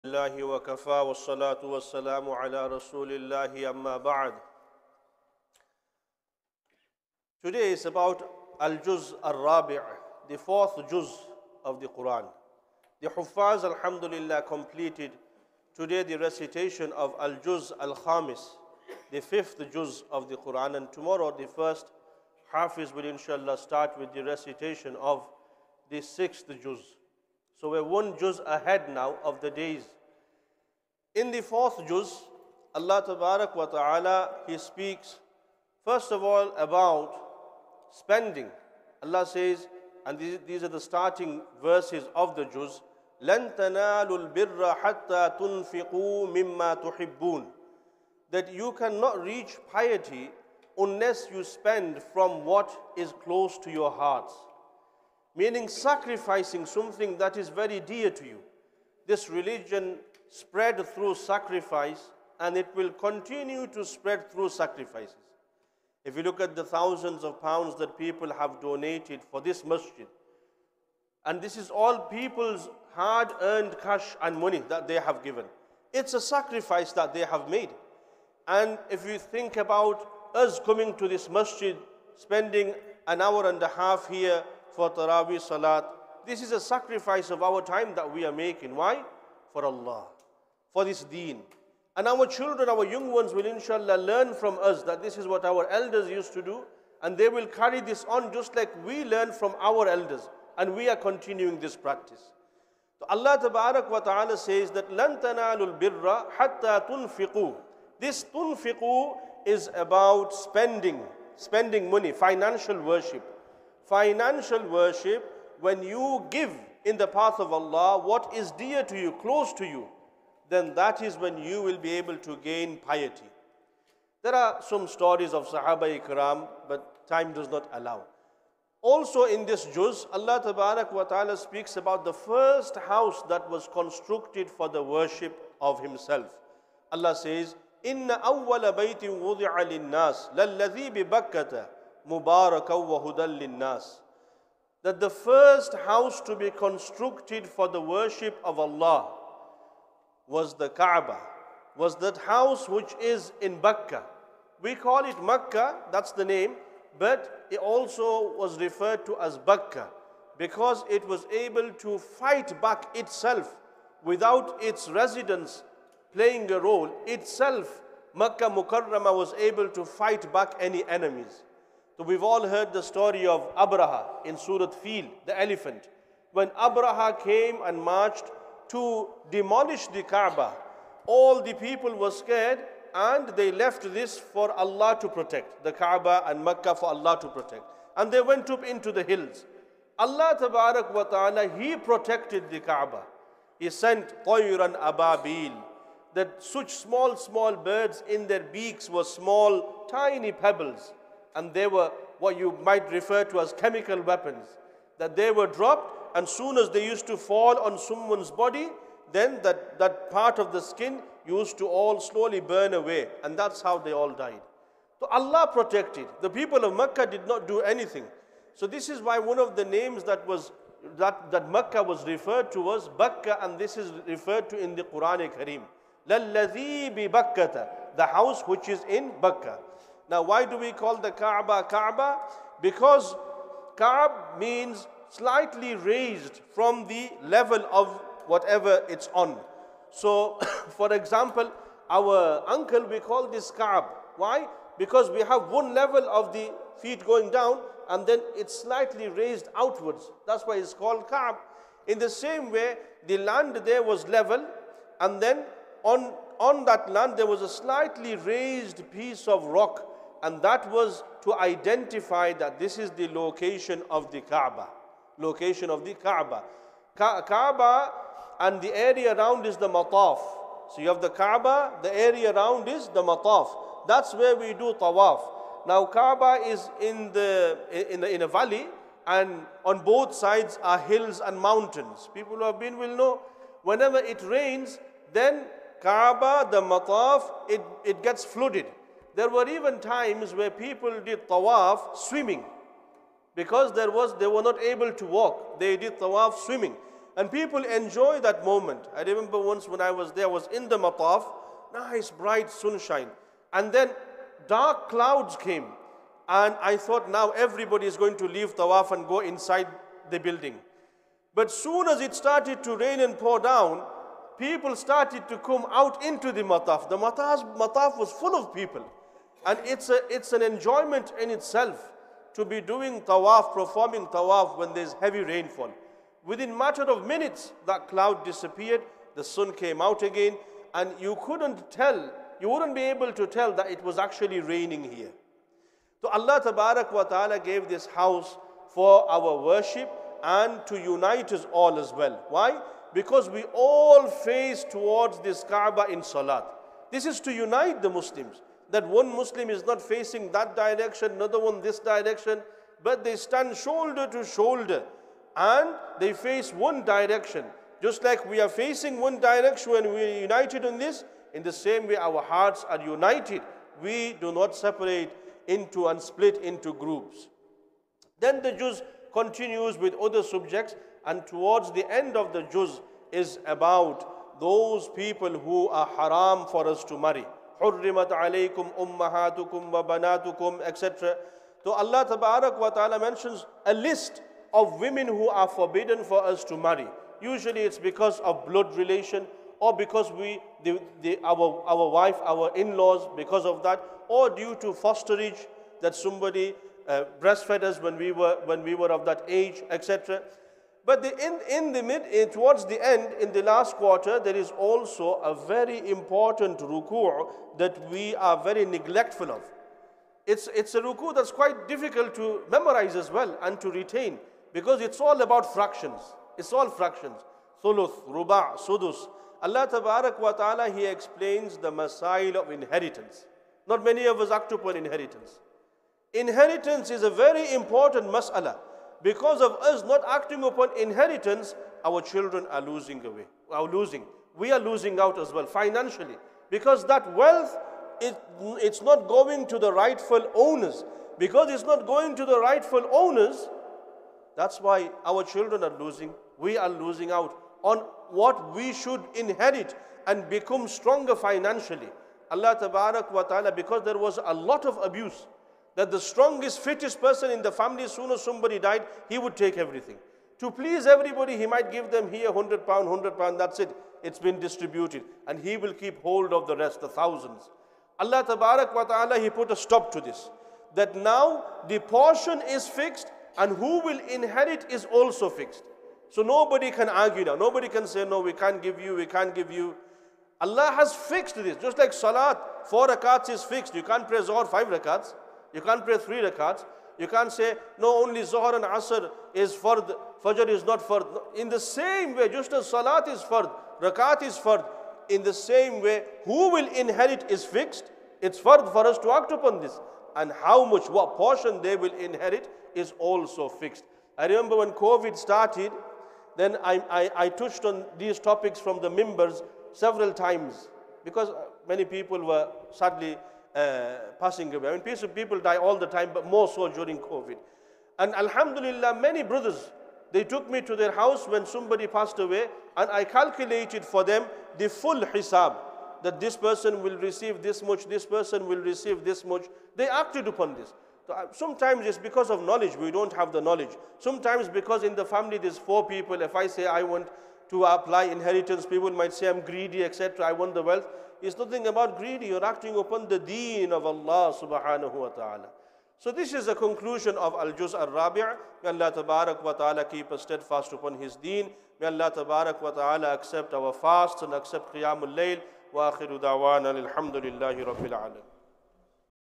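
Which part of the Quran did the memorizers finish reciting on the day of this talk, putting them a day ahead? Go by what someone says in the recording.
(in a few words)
The fifth Juz.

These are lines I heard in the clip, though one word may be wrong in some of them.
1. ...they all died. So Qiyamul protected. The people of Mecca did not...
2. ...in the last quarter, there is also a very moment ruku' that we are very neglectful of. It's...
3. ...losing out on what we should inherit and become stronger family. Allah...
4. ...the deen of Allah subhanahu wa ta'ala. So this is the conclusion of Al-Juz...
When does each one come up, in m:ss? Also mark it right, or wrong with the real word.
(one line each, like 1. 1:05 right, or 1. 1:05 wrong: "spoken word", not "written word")
1. 3:33 wrong: "Allah", not "Qiyamul"
2. 6:43 wrong: "important", not "moment"
3. 7:26 wrong: "financially", not "family"
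4. 9:03 right.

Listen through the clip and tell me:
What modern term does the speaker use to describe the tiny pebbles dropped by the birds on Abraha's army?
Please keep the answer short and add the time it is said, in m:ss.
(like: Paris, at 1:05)
Chemical weapons, at 3:23.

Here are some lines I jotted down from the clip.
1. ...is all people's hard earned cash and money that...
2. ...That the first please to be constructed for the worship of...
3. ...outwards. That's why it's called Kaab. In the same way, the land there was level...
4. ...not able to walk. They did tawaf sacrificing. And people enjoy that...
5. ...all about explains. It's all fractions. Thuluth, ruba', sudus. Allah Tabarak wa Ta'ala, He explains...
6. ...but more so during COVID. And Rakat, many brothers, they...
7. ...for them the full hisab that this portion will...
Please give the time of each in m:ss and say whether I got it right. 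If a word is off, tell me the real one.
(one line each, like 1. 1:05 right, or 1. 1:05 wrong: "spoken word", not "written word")
1. 1:11 right
2. 2:24 wrong: "house", not "please"
3. 4:09 right
4. 4:54 wrong: "swimming", not "sacrificing"
5. 6:54 wrong: "fractions", not "explains"
6. 8:36 wrong: "Alhamdulillah", not "Rakat"
7. 8:43 wrong: "person", not "portion".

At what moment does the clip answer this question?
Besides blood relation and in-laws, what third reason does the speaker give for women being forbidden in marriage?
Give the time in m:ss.
6:34.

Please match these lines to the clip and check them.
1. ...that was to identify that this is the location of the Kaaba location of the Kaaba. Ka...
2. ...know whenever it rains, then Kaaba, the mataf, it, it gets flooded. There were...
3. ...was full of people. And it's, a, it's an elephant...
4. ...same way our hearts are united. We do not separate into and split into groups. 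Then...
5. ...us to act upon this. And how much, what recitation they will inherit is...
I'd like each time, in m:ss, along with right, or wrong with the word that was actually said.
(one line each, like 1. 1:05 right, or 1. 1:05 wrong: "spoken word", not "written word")
1. 4:20 right
2. 4:42 right
3. 5:17 wrong: "enjoyment", not "elephant"
4. 6:01 right
5. 8:18 wrong: "portion", not "recitation".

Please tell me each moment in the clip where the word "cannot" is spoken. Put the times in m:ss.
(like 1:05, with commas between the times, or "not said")
0:48.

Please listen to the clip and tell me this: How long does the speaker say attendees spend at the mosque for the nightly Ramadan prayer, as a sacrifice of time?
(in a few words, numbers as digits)
An hour and a half.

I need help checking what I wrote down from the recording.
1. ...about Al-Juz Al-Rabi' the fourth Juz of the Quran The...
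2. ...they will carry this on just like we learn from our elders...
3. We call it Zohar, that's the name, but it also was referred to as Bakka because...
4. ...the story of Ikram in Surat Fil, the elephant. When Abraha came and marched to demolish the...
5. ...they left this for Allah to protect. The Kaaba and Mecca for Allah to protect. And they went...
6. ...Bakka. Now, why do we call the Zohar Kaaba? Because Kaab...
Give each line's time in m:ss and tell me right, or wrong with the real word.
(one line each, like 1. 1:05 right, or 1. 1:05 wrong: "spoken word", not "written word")
1. 0:07 right
2. 1:37 right
3. 2:34 wrong: "Mecca", not "Zohar"
4. 2:52 wrong: "Abraha", not "Ikram"
5. 3:03 right
6. 3:49 wrong: "Kaaba", not "Zohar".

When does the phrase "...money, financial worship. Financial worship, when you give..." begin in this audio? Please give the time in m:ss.
1:51.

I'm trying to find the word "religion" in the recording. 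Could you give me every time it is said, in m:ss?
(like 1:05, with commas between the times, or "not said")
0:59.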